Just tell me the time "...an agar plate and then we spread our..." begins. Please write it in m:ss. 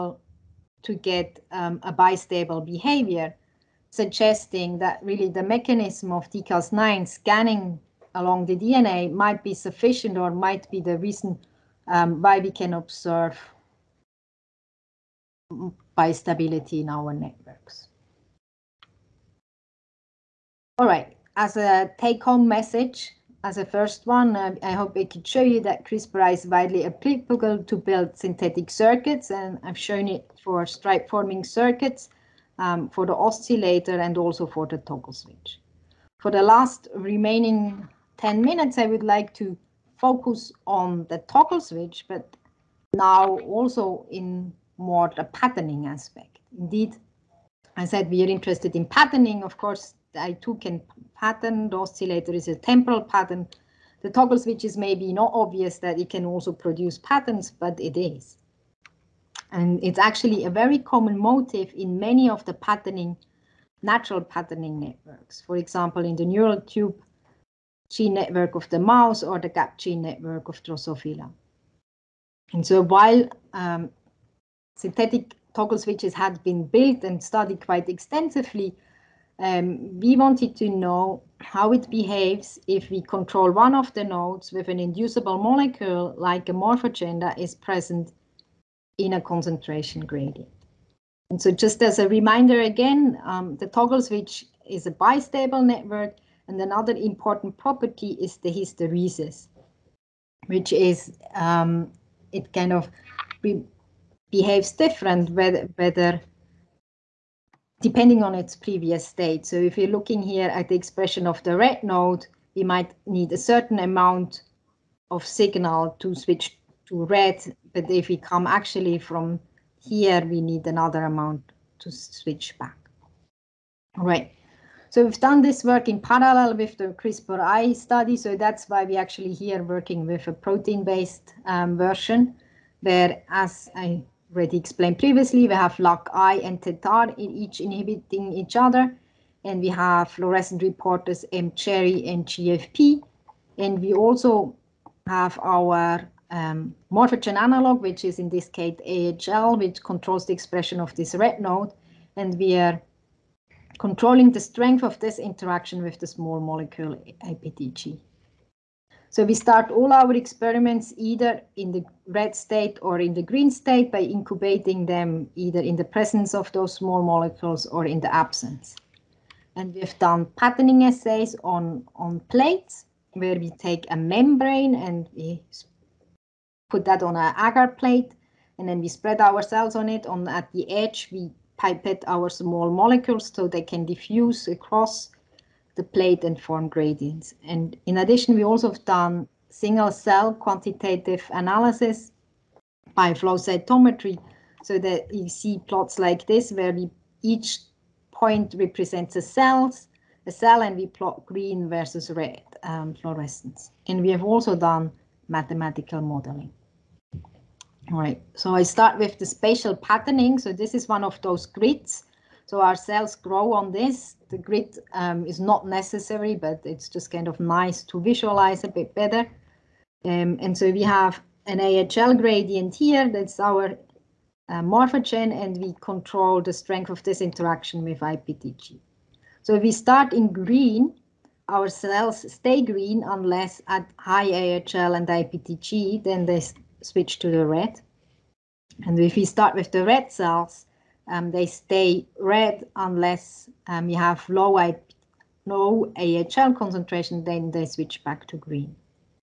2:57.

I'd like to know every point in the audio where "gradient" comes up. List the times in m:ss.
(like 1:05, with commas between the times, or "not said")
1:30, 3:06, 3:42.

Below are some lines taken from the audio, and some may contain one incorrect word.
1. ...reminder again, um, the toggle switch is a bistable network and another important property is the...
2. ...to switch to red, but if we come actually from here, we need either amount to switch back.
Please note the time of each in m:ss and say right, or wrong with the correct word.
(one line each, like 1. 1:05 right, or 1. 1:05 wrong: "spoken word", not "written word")
1. 1:32 right
2. 1:55 wrong: "another", not "either".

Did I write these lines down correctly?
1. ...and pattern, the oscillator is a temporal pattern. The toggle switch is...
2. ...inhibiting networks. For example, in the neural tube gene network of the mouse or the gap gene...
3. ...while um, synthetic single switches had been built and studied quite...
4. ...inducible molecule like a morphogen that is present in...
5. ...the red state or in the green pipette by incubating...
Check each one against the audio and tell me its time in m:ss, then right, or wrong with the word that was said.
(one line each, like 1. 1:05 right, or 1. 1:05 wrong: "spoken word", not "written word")
1. 0:50 right
2. 1:04 wrong: "patterning", not "inhibiting"
3. 1:12 wrong: "toggle", not "single"
4. 1:24 right
5. 2:41 wrong: "state", not "pipette".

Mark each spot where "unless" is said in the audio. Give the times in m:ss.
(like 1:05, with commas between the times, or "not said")
3:53, 4:02.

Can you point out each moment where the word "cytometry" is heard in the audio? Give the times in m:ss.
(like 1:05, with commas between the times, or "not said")
3:13.